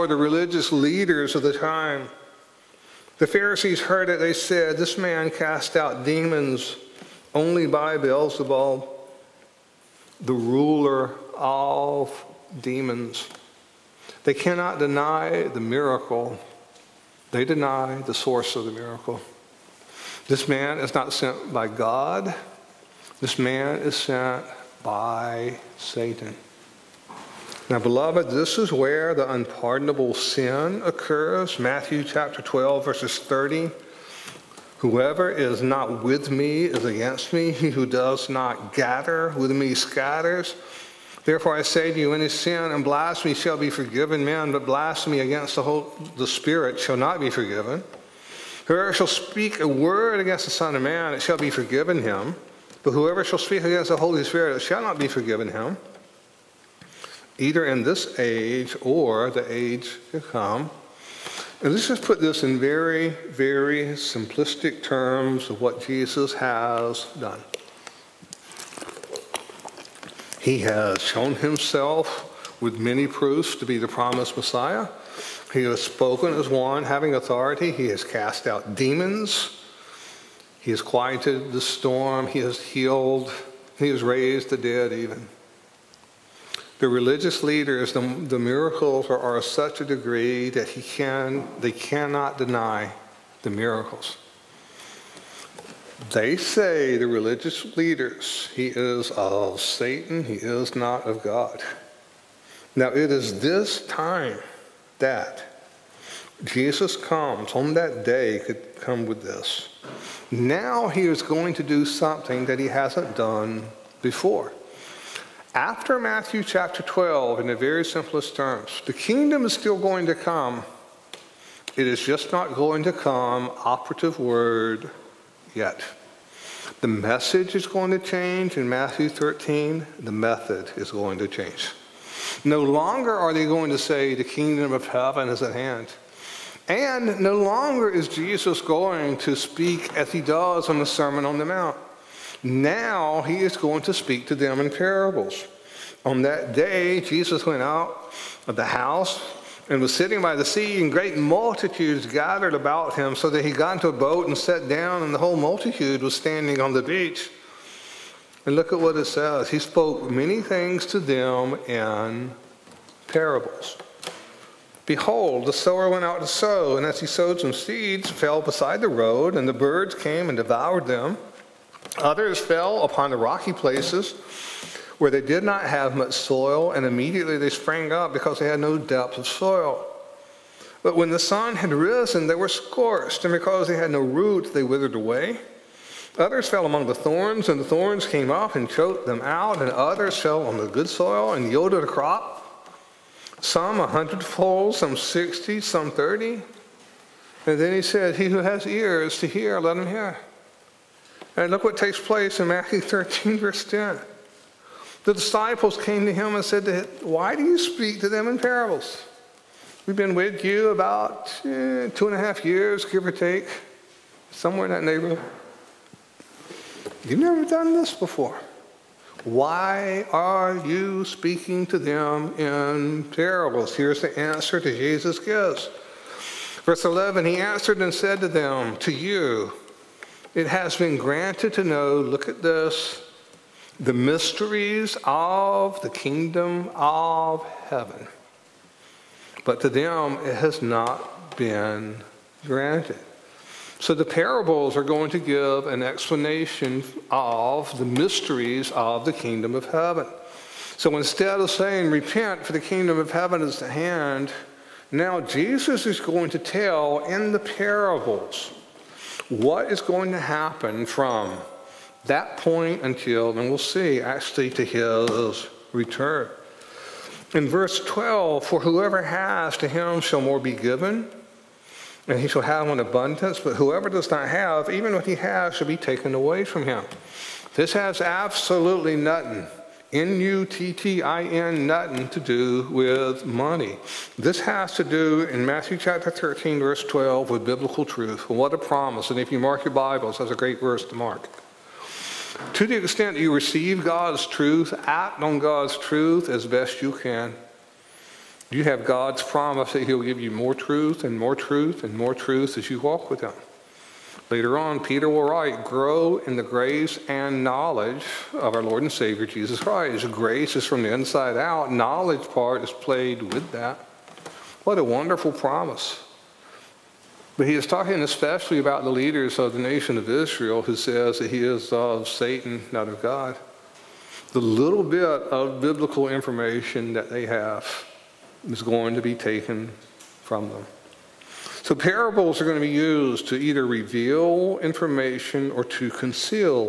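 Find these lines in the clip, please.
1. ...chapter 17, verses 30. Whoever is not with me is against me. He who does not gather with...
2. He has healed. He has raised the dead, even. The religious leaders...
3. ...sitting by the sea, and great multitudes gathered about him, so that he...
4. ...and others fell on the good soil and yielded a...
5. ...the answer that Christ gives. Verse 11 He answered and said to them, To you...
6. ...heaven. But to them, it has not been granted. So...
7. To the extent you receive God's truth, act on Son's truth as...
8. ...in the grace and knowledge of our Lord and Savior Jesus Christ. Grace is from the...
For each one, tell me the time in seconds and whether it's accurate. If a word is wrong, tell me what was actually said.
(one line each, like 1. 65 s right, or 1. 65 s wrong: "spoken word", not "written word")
1. 32 s wrong: "12", not "17"
2. 82 s right
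3. 149 s right
4. 189 s right
5. 224 s wrong: "Jesus", not "Christ"
6. 237 s right
7. 292 s wrong: "God", not "Son"
8. 306 s right.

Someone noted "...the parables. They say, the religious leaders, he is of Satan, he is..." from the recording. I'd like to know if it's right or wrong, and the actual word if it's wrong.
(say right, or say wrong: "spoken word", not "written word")
wrong: "miracles", not "parables".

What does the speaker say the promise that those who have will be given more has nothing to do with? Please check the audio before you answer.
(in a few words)
money.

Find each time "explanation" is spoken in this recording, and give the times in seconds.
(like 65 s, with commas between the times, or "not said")
245 s.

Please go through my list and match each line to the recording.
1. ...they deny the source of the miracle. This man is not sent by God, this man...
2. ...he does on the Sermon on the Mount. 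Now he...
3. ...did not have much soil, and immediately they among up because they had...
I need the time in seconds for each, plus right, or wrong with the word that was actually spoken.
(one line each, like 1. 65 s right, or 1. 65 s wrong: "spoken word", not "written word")
1. 17 s right
2. 140 s right
3. 175 s wrong: "sprang", not "among".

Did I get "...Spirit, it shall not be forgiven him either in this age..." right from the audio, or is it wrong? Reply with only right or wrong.
right.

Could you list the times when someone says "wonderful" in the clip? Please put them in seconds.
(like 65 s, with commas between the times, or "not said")
314 s.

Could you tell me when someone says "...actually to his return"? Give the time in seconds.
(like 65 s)
264 s.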